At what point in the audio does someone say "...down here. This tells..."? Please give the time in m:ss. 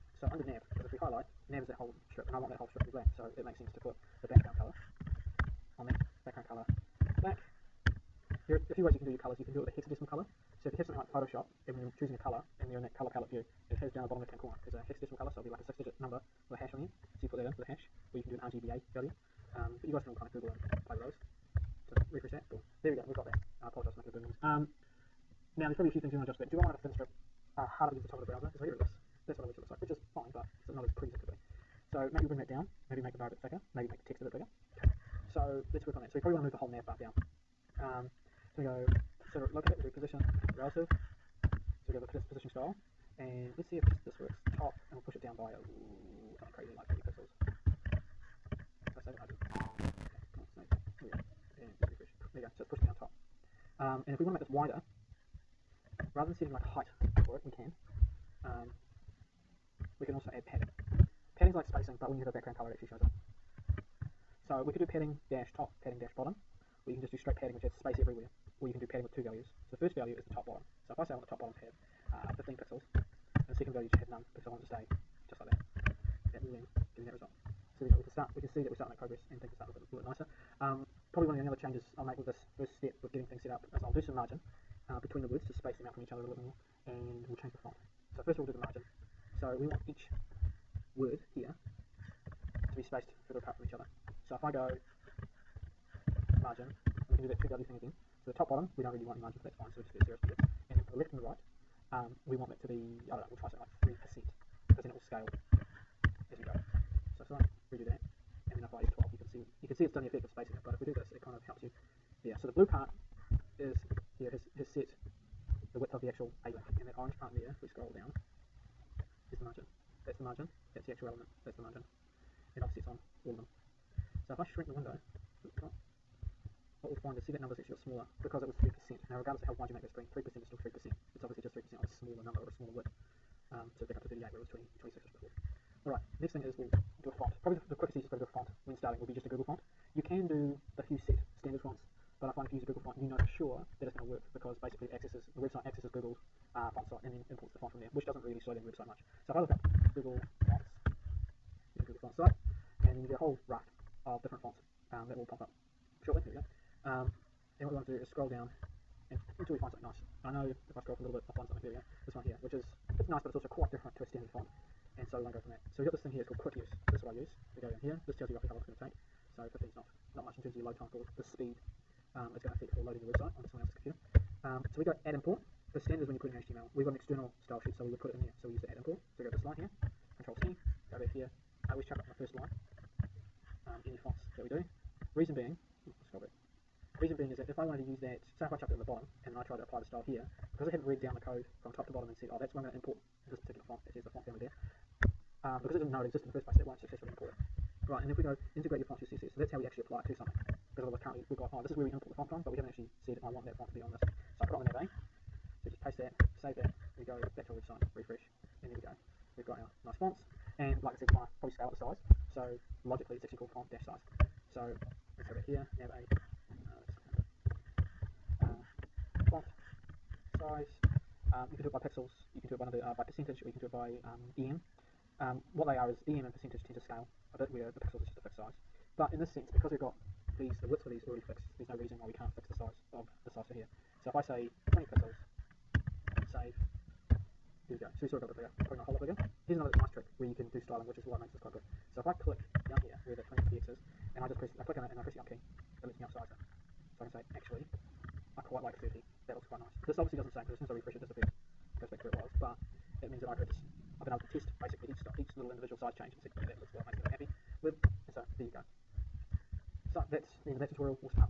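2:47.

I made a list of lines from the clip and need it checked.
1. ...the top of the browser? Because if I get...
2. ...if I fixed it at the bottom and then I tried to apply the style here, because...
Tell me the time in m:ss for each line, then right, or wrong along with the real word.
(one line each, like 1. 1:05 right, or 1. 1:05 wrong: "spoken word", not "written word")
1. 0:28 right
2. 3:08 wrong: "chucked", not "fixed".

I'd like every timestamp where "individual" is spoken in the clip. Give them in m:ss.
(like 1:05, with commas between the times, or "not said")
4:15.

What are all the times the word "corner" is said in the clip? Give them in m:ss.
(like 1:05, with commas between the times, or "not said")
0:14.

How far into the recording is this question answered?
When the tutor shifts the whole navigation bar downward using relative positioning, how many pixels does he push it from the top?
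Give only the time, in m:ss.
0:46.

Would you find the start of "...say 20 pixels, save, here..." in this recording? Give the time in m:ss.
3:54.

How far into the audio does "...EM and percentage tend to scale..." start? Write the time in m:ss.
3:46.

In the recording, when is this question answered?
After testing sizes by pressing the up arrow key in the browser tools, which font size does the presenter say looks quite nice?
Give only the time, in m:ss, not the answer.
4:08.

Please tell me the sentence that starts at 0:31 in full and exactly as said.
So maybe we'll bring that down, maybe make the bar a bit thicker, maybe make the text a bit bigger.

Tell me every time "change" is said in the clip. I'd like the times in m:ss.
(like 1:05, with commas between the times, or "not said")
1:21, 1:27, 4:15.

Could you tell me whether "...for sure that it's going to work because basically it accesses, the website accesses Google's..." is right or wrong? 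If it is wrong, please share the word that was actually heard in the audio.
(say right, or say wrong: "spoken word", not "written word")
right.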